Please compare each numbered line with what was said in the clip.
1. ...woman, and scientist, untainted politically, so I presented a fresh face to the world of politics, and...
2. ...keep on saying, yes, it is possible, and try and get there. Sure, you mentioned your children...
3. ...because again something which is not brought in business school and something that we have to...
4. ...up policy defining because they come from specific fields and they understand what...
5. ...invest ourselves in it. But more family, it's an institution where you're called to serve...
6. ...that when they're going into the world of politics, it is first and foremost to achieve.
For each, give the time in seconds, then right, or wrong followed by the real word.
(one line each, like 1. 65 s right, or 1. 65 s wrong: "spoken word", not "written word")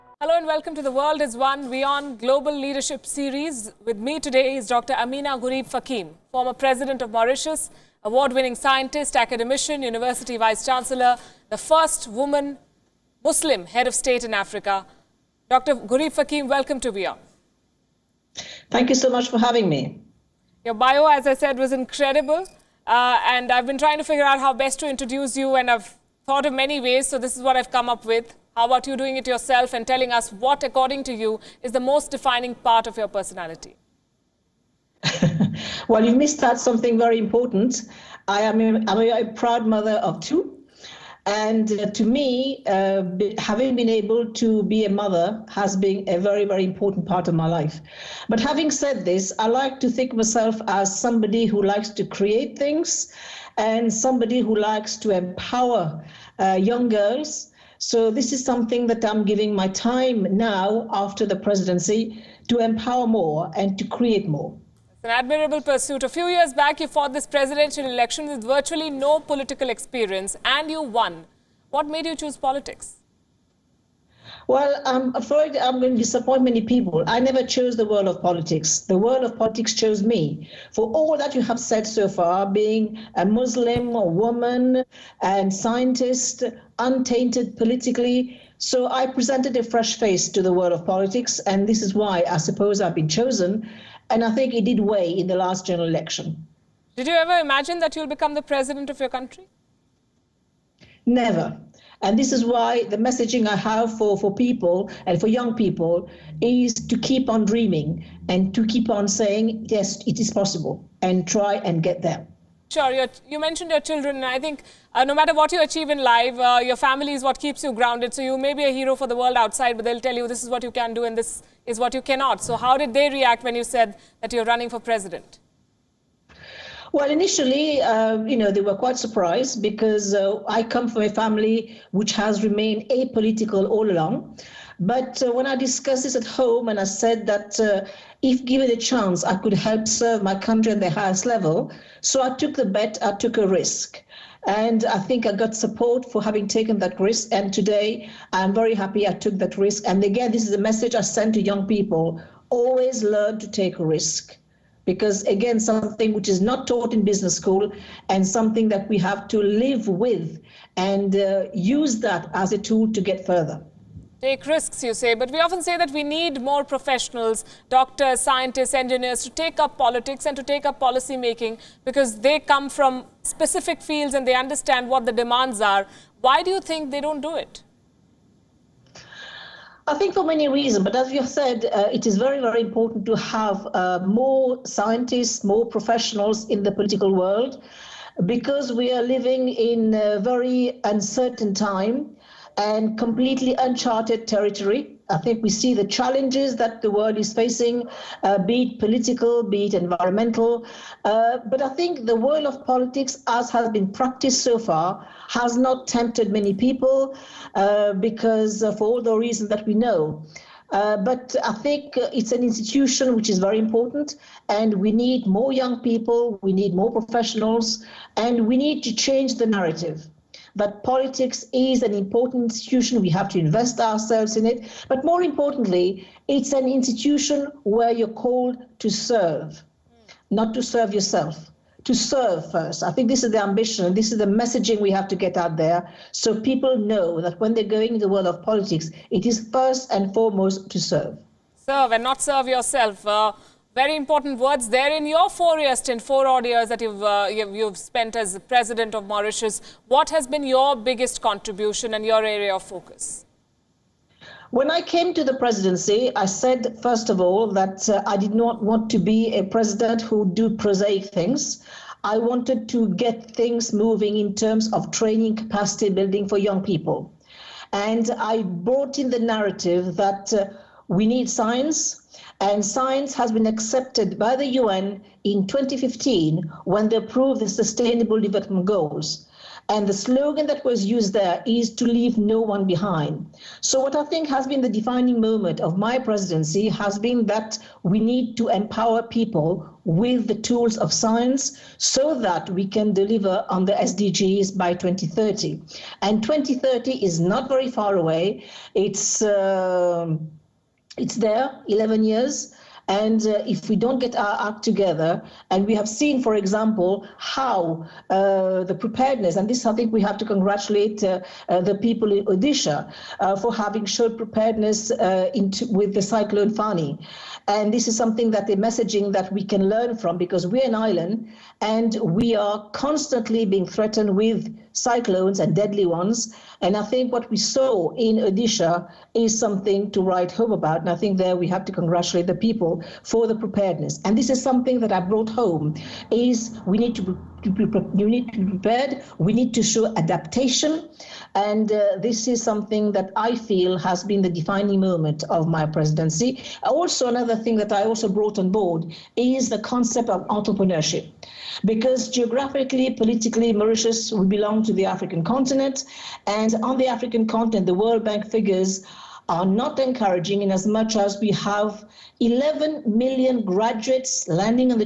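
1. 84 s right
2. 108 s right
3. 154 s wrong: "taught", not "brought"
4. 170 s wrong: "making", not "defining"
5. 223 s wrong: "importantly", not "family"
6. 237 s wrong: "serve", not "achieve".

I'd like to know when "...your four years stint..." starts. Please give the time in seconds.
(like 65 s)
245 s.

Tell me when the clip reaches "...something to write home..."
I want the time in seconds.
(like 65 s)
329 s.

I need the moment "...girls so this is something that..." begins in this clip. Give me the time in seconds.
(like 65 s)
56 s.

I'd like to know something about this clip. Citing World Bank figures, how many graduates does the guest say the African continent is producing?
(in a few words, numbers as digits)
11 million.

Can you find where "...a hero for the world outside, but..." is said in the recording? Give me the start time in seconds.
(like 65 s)
118 s.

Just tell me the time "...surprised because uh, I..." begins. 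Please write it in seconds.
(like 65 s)
128 s.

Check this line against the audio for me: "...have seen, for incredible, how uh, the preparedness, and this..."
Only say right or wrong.
wrong.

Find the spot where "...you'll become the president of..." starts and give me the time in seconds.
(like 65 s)
97 s.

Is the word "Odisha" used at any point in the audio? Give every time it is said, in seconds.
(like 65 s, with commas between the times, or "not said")
312 s, 328 s.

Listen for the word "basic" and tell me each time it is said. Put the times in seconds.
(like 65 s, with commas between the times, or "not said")
not said.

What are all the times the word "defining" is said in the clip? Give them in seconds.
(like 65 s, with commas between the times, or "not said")
32 s, 284 s, 344 s.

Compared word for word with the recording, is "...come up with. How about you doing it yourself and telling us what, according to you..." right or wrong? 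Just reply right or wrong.
right.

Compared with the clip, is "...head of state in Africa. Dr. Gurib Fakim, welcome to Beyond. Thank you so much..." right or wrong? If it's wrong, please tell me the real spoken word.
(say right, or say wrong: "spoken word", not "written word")
right.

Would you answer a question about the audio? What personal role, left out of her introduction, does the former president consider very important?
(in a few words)
mother of two.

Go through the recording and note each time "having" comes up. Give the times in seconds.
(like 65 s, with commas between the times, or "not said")
19 s, 43 s, 48 s, 146 s, 313 s.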